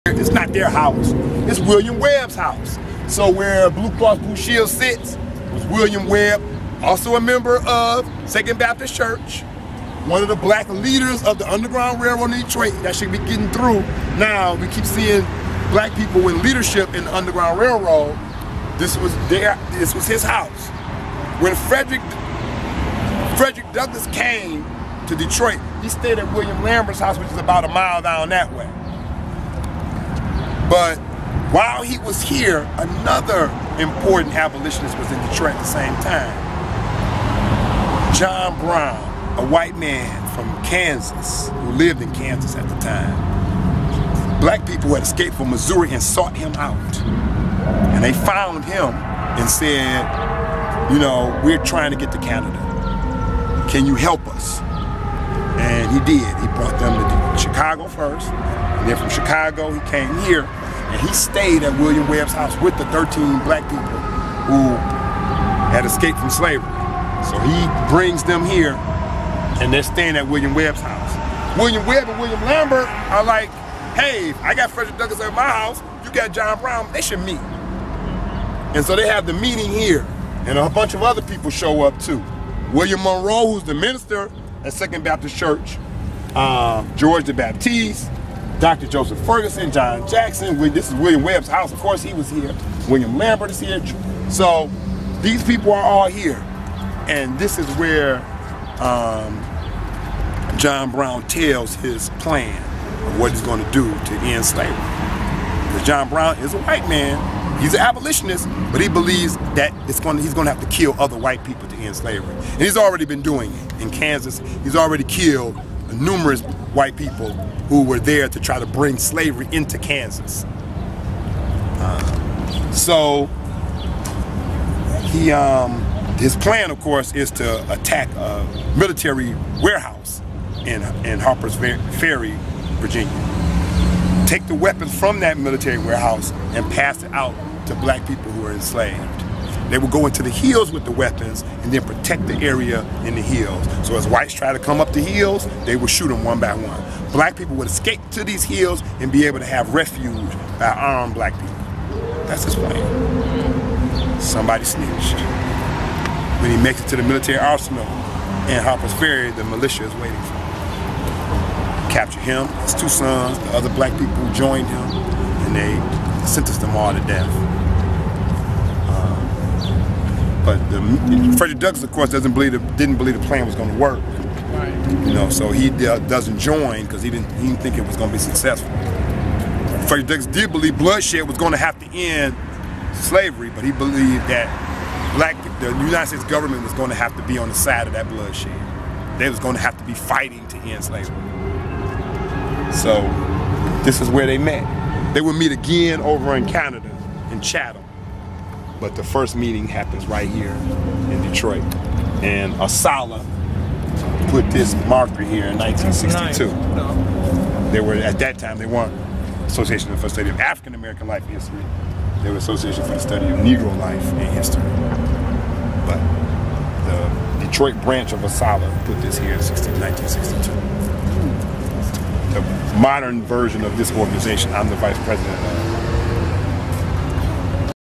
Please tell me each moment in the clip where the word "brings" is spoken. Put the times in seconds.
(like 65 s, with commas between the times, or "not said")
67 s, 118 s.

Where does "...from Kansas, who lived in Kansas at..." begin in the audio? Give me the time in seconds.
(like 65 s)
40 s.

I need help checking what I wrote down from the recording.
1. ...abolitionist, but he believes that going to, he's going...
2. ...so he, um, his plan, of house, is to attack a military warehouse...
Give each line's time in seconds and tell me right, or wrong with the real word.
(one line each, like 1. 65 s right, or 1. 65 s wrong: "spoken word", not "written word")
1. 107 s right
2. 122 s wrong: "course", not "house".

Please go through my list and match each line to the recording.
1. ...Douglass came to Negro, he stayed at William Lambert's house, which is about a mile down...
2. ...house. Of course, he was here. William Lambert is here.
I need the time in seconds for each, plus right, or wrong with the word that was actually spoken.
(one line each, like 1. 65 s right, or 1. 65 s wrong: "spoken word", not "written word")
1. 23 s wrong: "Detroit", not "Negro"
2. 91 s right.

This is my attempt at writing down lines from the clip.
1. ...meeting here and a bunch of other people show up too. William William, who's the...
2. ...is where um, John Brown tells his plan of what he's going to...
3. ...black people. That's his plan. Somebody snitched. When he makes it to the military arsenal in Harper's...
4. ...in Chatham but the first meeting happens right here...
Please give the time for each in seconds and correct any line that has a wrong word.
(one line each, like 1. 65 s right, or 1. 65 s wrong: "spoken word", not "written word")
1. 79 s wrong: "Monroe", not "William"
2. 97 s right
3. 151 s right
4. 197 s right.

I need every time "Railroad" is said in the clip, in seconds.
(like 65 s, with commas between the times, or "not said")
12 s, 17 s.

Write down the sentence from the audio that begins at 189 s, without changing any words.
They was going to have to be fighting to end slavery.